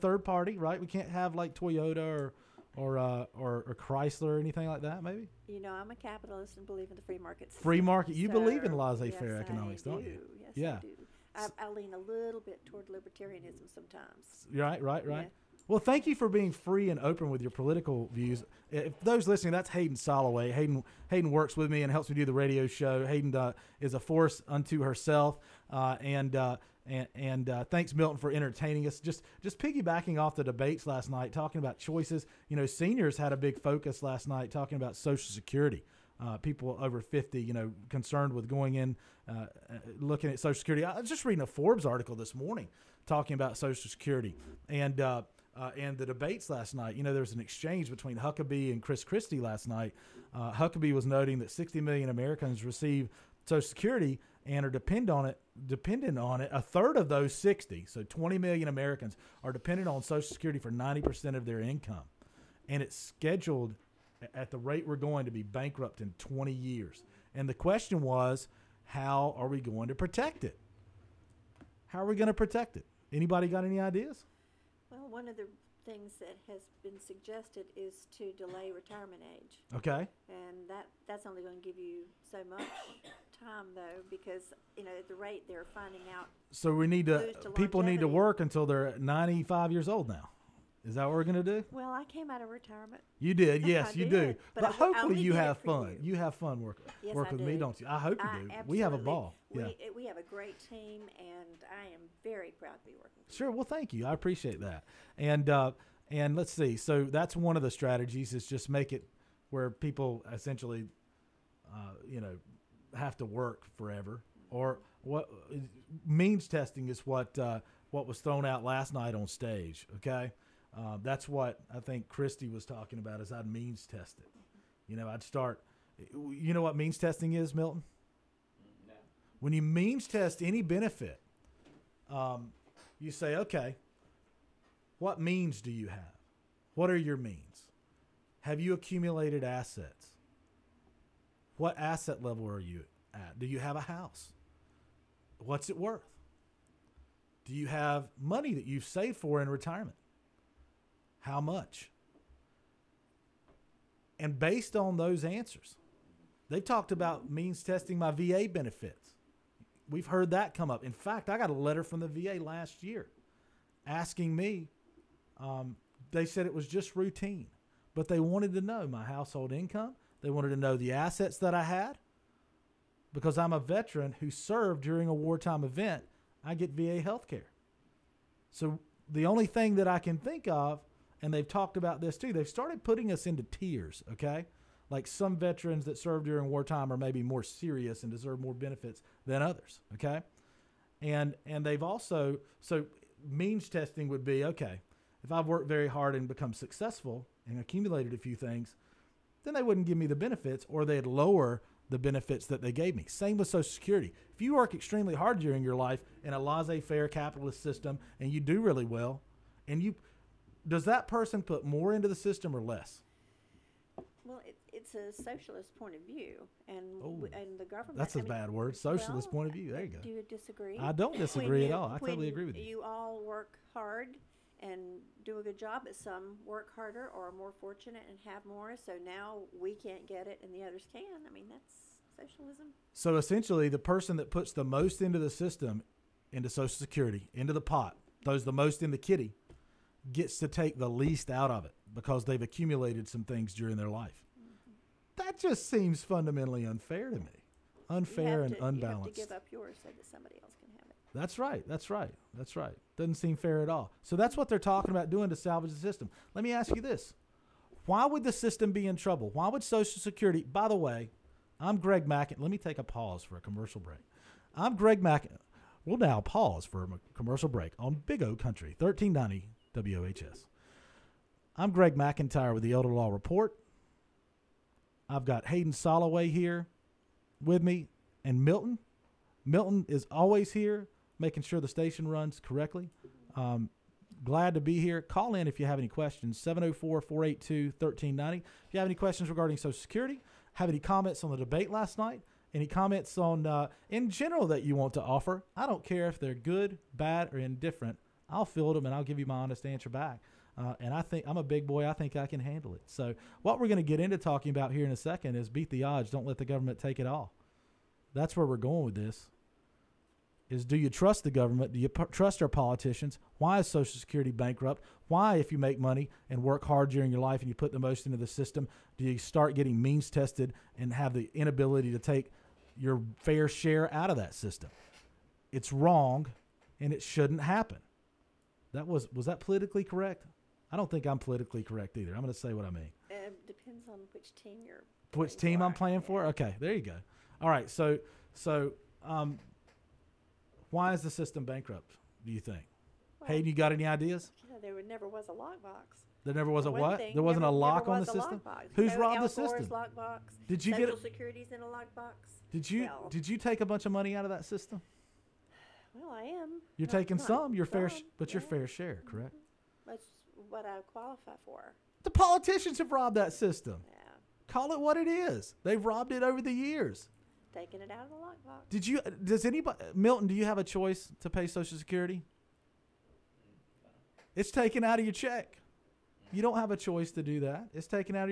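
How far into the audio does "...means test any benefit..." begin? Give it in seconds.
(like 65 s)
129 s.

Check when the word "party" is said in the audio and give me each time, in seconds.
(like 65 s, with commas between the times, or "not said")
0 s.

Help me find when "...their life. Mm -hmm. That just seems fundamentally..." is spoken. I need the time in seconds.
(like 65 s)
243 s.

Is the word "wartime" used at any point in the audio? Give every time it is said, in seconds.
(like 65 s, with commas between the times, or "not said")
175 s, 186 s.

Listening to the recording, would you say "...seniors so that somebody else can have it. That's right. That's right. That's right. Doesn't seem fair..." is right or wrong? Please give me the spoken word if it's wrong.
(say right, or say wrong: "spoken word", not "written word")
wrong: "yours", not "seniors".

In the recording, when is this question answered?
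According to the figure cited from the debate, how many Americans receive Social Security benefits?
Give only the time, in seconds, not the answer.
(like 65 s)
51 s.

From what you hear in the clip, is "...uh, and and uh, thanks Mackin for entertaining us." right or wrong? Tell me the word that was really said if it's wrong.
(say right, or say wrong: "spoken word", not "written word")
wrong: "Milton", not "Mackin".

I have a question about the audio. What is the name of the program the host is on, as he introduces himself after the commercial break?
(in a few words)
Elder Law Report.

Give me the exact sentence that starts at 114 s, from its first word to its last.
Or what means testing is what uh, what was thrown out last night on stage.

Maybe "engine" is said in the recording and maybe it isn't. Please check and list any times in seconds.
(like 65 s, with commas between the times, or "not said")
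not said.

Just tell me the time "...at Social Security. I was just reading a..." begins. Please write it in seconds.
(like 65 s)
40 s.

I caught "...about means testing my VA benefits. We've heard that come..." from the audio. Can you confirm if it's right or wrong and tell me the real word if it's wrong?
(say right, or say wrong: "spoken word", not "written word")
right.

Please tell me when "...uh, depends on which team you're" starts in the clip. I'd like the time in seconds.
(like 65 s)
333 s.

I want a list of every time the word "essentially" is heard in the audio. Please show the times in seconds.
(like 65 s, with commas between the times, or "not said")
110 s, 233 s.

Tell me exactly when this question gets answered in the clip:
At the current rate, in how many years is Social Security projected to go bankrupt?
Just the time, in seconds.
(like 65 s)
66 s.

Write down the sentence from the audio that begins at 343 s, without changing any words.
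Well, Hayden, you got any ideas?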